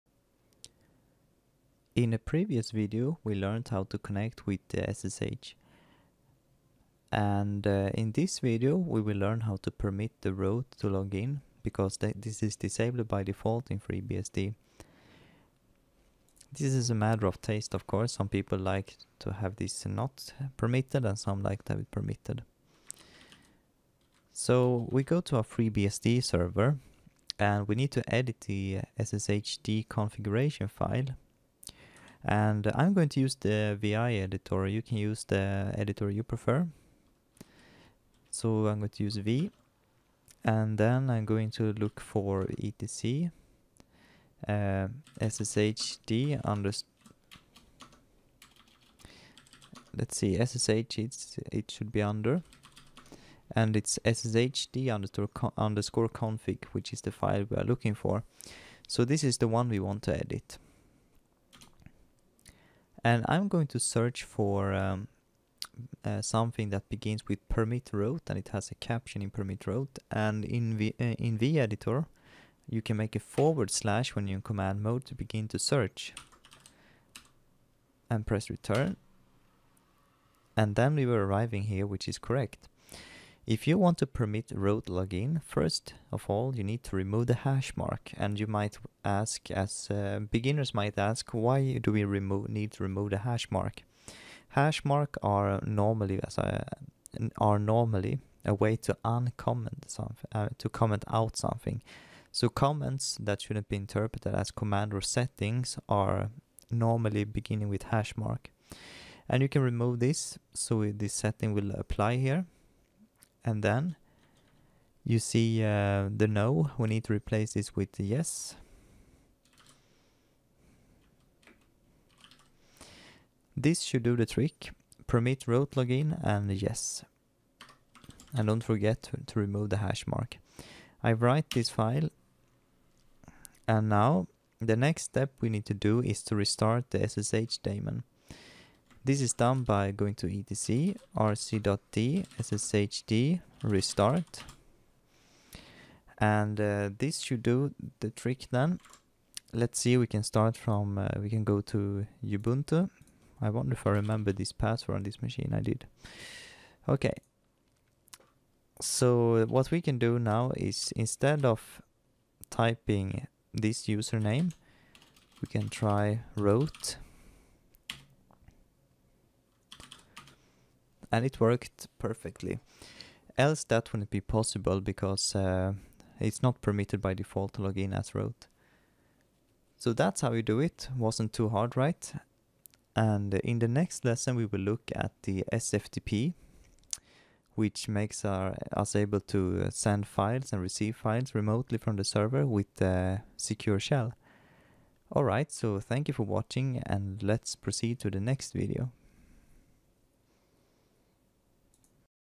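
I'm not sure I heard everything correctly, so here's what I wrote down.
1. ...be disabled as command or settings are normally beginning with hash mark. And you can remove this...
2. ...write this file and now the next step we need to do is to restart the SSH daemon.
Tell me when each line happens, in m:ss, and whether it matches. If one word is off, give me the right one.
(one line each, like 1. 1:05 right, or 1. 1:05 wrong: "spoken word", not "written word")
1. 1:43 wrong: "interpreted", not "disabled"
2. 2:11 right.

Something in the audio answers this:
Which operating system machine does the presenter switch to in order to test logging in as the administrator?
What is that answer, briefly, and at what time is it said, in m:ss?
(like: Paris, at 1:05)
Ubuntu, at 2:32.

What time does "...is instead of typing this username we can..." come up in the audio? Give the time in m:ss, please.
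2:40.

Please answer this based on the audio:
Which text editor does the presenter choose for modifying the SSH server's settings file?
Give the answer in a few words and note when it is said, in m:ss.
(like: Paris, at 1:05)
VI, at 0:33.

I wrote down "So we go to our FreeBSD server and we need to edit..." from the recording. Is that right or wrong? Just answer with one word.
right.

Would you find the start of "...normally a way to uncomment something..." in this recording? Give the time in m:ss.
1:37.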